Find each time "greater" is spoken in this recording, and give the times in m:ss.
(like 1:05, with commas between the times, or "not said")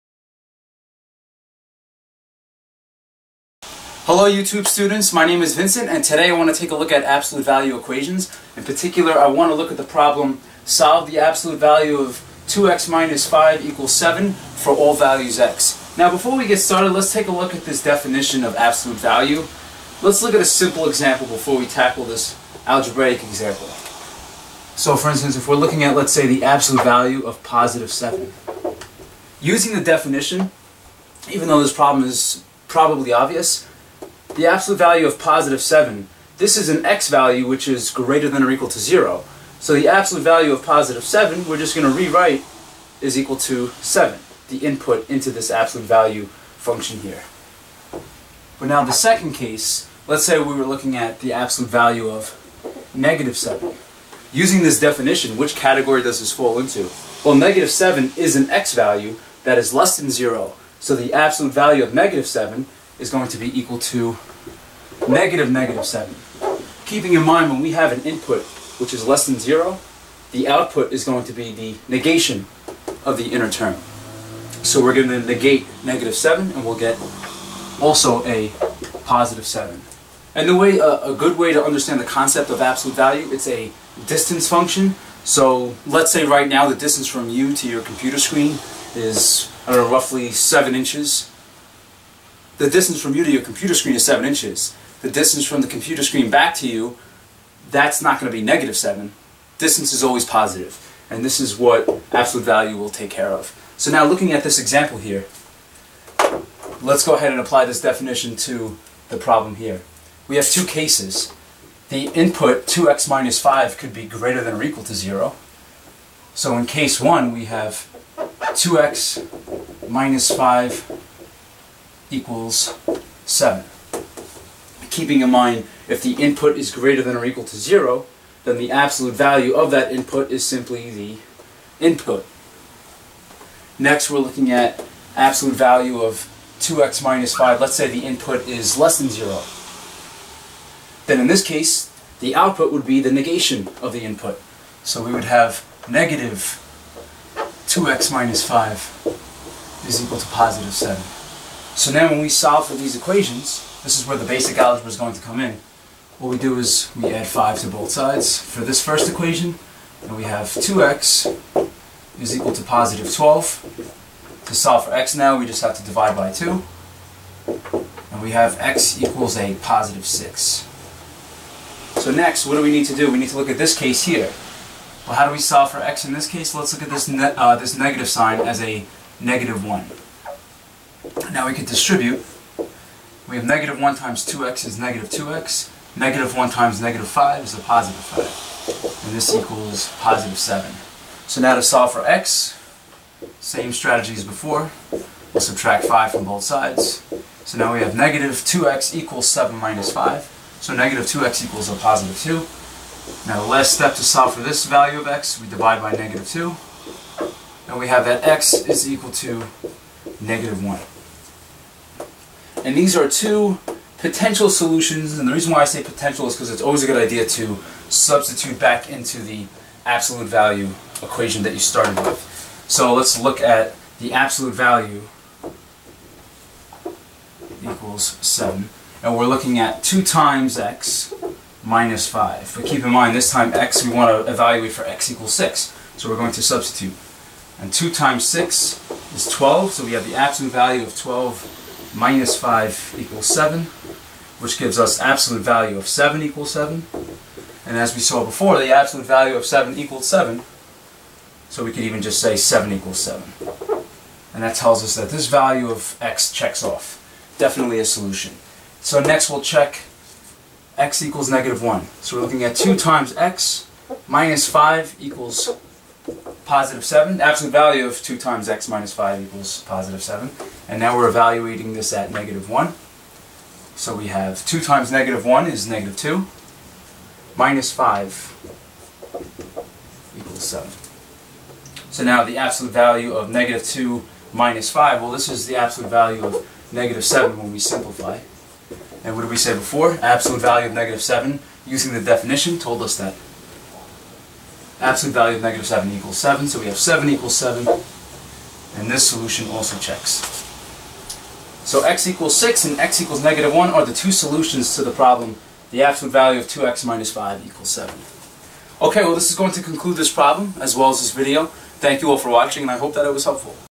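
0:37, 1:54, 2:06.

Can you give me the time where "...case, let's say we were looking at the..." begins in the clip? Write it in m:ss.
0:49.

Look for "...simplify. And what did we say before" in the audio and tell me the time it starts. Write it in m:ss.
4:47.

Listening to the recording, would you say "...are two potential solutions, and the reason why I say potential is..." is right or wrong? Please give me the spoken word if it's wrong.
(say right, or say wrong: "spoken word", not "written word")
right.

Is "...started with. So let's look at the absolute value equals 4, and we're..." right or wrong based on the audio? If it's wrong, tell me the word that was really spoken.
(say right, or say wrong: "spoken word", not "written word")
wrong: "7", not "4".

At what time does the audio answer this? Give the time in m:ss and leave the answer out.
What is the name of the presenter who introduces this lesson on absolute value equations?
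0:05.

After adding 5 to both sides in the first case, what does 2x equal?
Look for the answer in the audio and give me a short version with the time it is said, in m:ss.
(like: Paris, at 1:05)
12, at 2:42.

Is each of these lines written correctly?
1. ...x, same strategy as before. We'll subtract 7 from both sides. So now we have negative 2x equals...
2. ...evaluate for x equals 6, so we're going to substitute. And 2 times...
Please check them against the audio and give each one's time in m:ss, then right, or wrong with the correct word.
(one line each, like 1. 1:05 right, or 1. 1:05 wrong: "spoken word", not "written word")
1. 3:12 wrong: "5", not "7"
2. 3:54 right.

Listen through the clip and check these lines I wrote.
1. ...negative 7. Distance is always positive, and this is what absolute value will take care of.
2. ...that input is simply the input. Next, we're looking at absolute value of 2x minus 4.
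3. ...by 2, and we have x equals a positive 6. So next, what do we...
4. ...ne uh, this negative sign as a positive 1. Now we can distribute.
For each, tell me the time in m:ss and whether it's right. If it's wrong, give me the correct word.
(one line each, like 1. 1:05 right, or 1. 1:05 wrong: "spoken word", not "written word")
1. 1:38 right
2. 2:09 wrong: "5", not "4"
3. 2:46 right
4. 2:57 wrong: "negative", not "positive".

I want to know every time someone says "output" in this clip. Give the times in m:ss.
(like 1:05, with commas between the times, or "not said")
1:10, 2:22.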